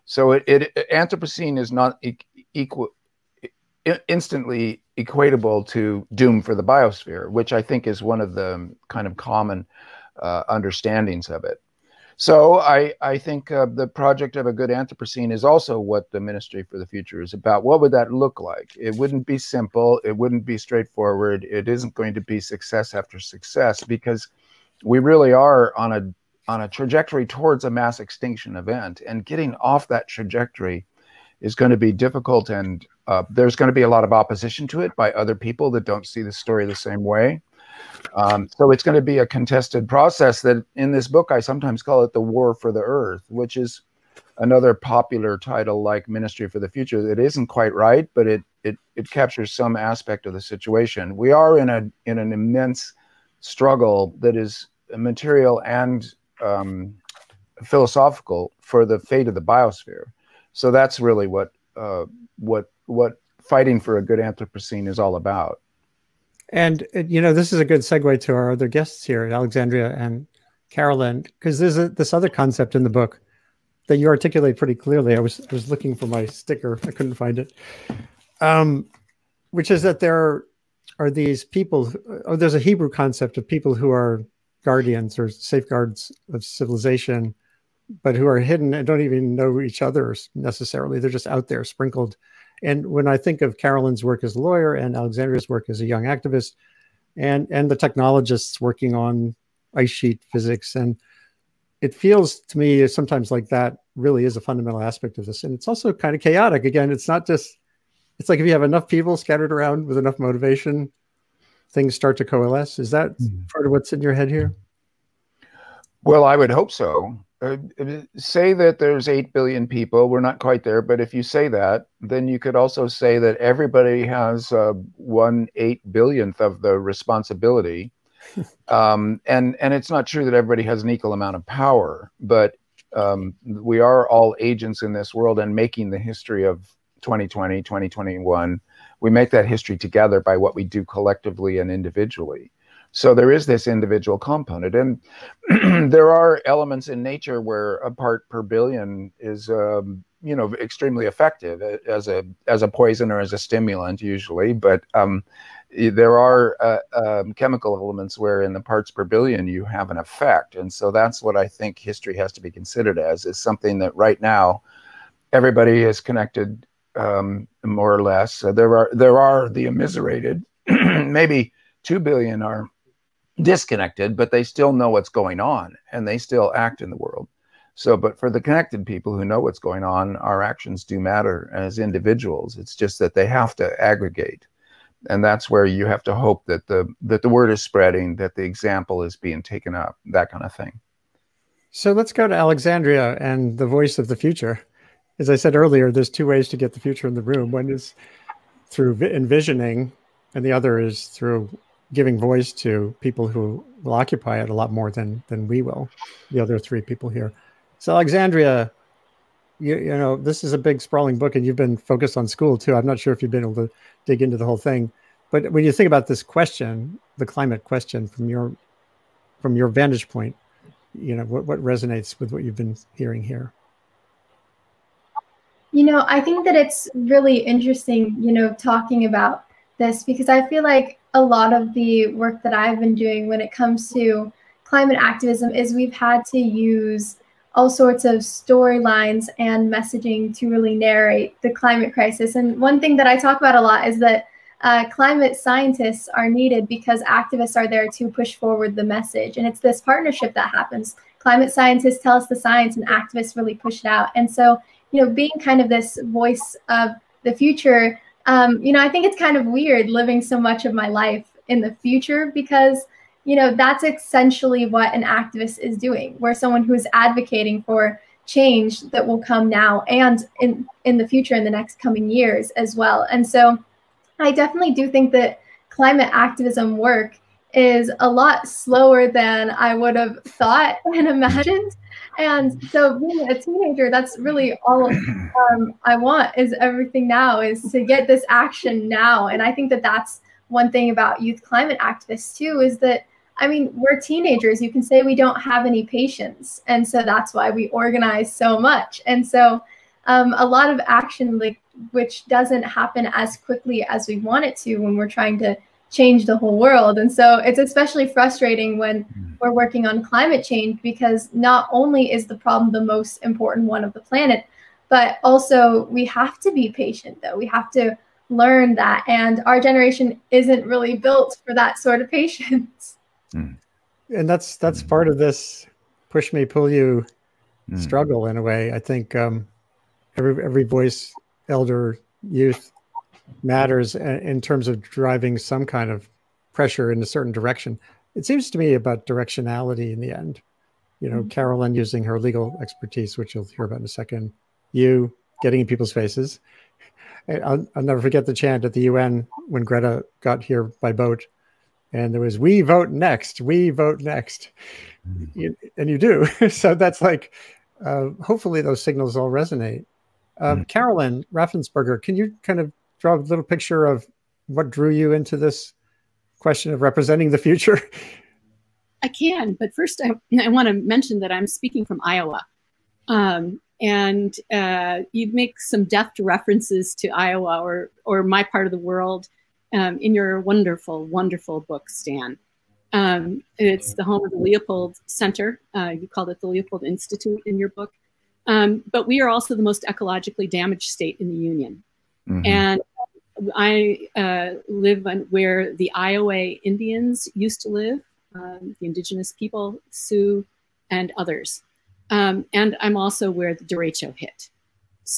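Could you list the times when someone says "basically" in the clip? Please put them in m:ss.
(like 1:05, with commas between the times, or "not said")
not said.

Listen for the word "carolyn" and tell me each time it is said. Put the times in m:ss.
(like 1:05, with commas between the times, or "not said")
1:10, 1:33, 5:41, 6:00.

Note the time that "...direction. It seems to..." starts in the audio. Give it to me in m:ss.
5:37.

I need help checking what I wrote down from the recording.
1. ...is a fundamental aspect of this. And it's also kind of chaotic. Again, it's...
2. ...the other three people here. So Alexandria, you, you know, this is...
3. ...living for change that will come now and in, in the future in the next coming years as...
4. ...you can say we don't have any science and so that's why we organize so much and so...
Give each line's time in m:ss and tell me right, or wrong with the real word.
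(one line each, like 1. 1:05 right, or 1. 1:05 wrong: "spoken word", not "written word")
1. 1:44 right
2. 3:26 right
3. 4:26 wrong: "advocating", not "living"
4. 4:54 wrong: "patience", not "science".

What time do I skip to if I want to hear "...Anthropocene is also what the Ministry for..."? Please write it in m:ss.
0:14.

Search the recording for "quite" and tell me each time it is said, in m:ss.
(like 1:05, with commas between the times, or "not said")
0:47, 2:00.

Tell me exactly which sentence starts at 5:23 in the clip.
And that's that's part of this push me, pull you mm.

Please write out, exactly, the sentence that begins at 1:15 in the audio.
I was I was looking for my sticker, I couldn't find it.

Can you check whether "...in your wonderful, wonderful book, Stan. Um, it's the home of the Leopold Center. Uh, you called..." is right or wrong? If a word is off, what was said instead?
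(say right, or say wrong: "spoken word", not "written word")
right.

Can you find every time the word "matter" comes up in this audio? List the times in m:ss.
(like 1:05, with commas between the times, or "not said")
3:00, 5:33.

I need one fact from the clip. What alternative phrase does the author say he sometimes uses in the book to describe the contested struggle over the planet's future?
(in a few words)
the war for the earth.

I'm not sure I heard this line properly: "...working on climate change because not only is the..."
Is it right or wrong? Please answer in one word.
right.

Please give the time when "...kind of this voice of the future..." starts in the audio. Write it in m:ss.
4:15.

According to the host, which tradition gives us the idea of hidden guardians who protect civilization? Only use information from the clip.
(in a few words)
Hebrew.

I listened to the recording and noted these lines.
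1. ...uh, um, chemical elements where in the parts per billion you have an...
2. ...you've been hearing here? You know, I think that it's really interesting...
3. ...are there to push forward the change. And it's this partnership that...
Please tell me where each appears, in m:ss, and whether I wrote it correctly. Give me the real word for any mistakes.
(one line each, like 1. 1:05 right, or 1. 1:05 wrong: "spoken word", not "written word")
1. 2:36 right
2. 3:42 right
3. 4:07 wrong: "message", not "change".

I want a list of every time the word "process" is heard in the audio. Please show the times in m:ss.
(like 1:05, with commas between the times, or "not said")
0:39.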